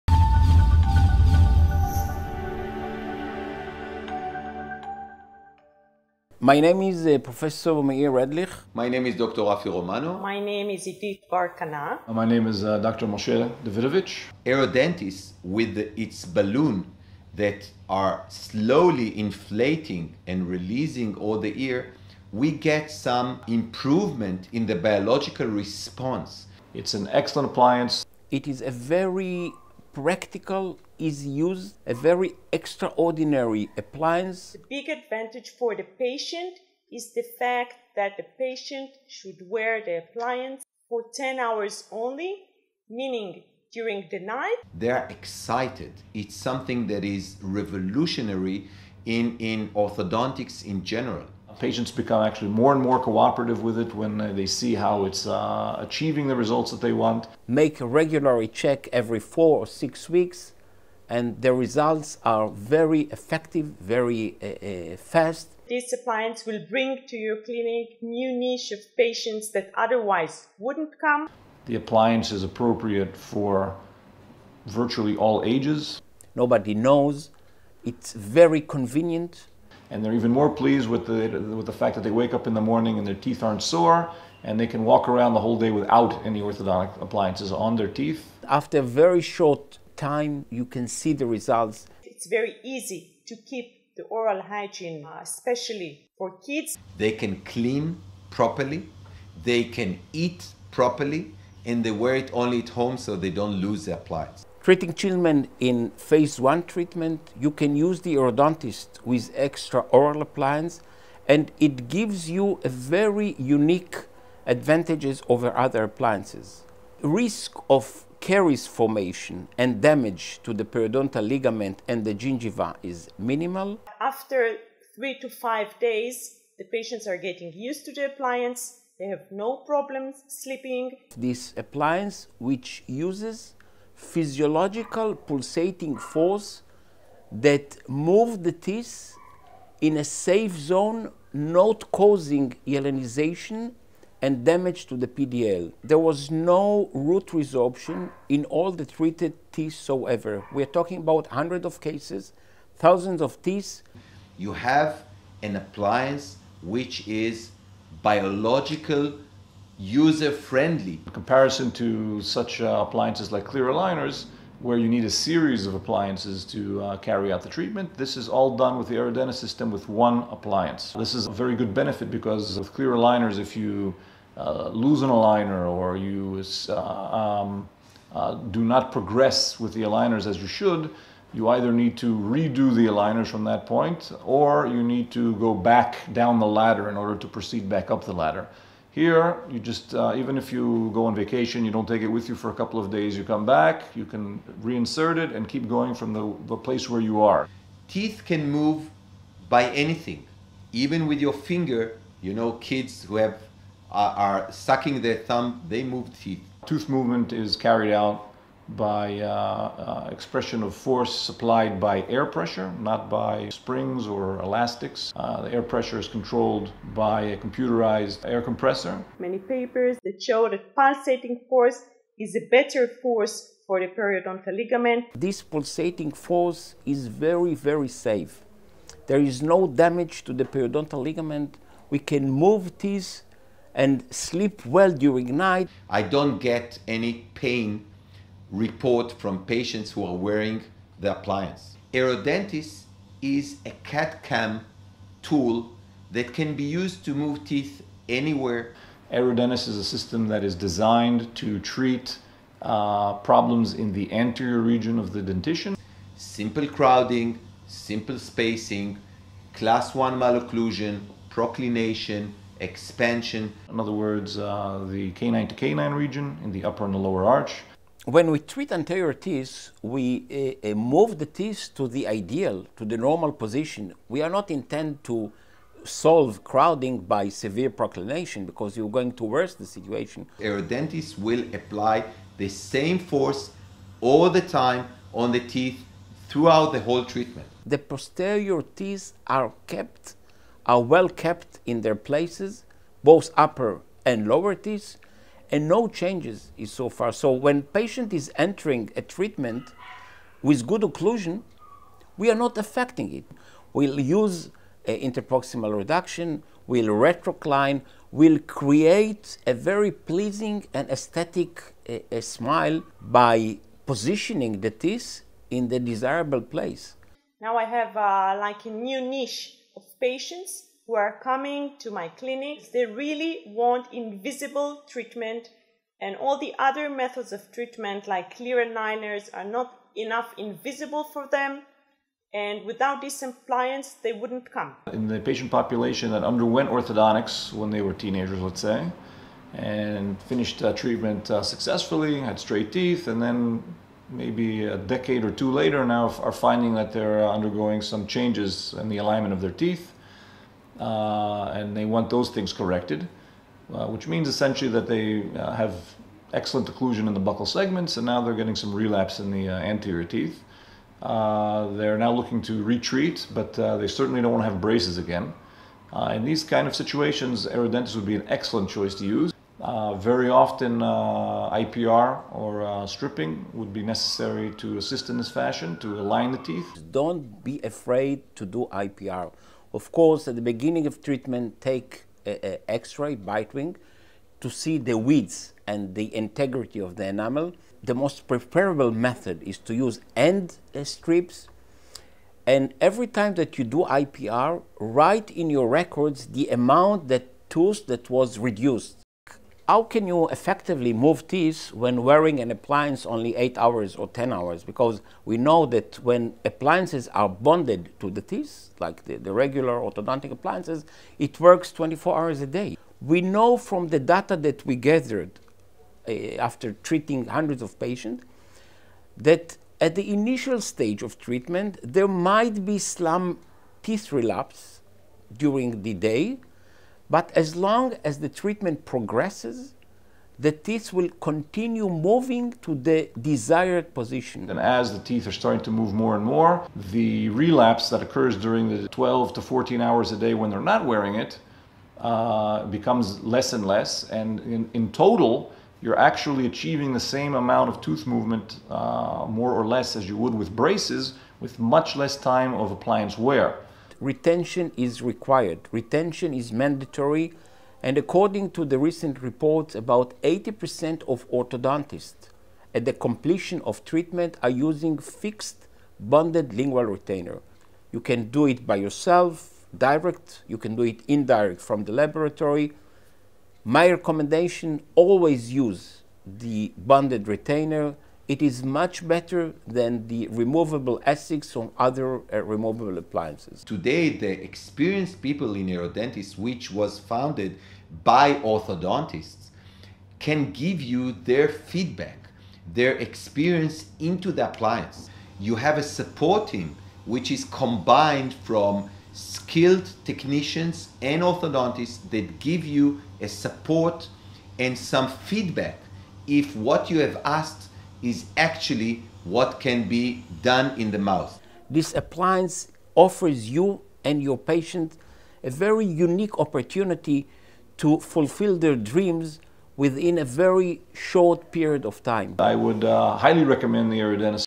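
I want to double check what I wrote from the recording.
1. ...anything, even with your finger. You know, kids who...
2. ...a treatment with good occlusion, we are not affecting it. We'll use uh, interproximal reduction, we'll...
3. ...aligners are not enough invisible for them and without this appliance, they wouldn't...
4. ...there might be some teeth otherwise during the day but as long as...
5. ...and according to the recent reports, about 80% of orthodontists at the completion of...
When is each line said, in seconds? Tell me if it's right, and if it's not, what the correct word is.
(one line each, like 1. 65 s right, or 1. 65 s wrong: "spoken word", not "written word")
1. 199 s right
2. 298 s right
3. 328 s right
4. 421 s wrong: "relapse", not "otherwise"
5. 457 s right.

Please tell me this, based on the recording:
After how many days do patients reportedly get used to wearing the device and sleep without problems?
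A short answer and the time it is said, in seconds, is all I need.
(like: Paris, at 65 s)
3 to 5 days, at 124 s.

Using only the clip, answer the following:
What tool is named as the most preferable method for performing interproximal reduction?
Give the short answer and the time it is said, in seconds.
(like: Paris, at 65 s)
end strips, at 390 s.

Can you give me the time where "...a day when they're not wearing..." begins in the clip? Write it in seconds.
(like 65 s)
440 s.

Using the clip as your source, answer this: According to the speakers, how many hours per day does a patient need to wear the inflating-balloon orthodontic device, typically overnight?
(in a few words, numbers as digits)
10 hours.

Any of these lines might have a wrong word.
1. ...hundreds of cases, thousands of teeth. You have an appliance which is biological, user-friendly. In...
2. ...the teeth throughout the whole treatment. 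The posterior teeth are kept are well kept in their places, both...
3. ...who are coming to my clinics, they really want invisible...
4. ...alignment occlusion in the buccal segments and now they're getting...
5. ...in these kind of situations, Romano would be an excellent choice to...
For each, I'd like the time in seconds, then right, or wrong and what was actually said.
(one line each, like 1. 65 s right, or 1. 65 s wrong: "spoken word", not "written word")
1. 151 s right
2. 285 s right
3. 320 s right
4. 356 s wrong: "excellent", not "alignment"
5. 366 s wrong: "Aerodentis", not "Romano".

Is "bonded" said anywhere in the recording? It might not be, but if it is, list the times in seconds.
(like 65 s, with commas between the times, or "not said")
407 s, 465 s, 476 s.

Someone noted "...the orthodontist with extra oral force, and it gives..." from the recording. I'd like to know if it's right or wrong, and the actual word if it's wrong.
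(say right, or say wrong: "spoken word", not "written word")
wrong: "appliance", not "force".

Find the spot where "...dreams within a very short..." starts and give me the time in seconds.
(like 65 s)
518 s.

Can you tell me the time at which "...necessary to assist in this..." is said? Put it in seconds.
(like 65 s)
373 s.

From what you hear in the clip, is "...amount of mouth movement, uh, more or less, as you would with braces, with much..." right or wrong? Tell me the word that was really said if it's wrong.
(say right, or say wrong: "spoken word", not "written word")
wrong: "tooth", not "mouth".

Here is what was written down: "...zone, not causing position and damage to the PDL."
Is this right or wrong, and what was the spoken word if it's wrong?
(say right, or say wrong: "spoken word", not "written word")
wrong: "hyalinization", not "position".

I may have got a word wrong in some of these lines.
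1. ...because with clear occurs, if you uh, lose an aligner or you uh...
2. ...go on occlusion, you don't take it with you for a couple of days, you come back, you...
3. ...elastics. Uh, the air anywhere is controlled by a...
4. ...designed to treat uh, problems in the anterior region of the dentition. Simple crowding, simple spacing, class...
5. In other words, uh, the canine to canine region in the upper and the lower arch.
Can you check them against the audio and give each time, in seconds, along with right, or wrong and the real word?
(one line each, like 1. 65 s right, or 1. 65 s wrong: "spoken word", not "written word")
1. 172 s wrong: "aligners", not "occurs"
2. 190 s wrong: "vacation", not "occlusion"
3. 214 s wrong: "pressure", not "anywhere"
4. 250 s right
5. 263 s right.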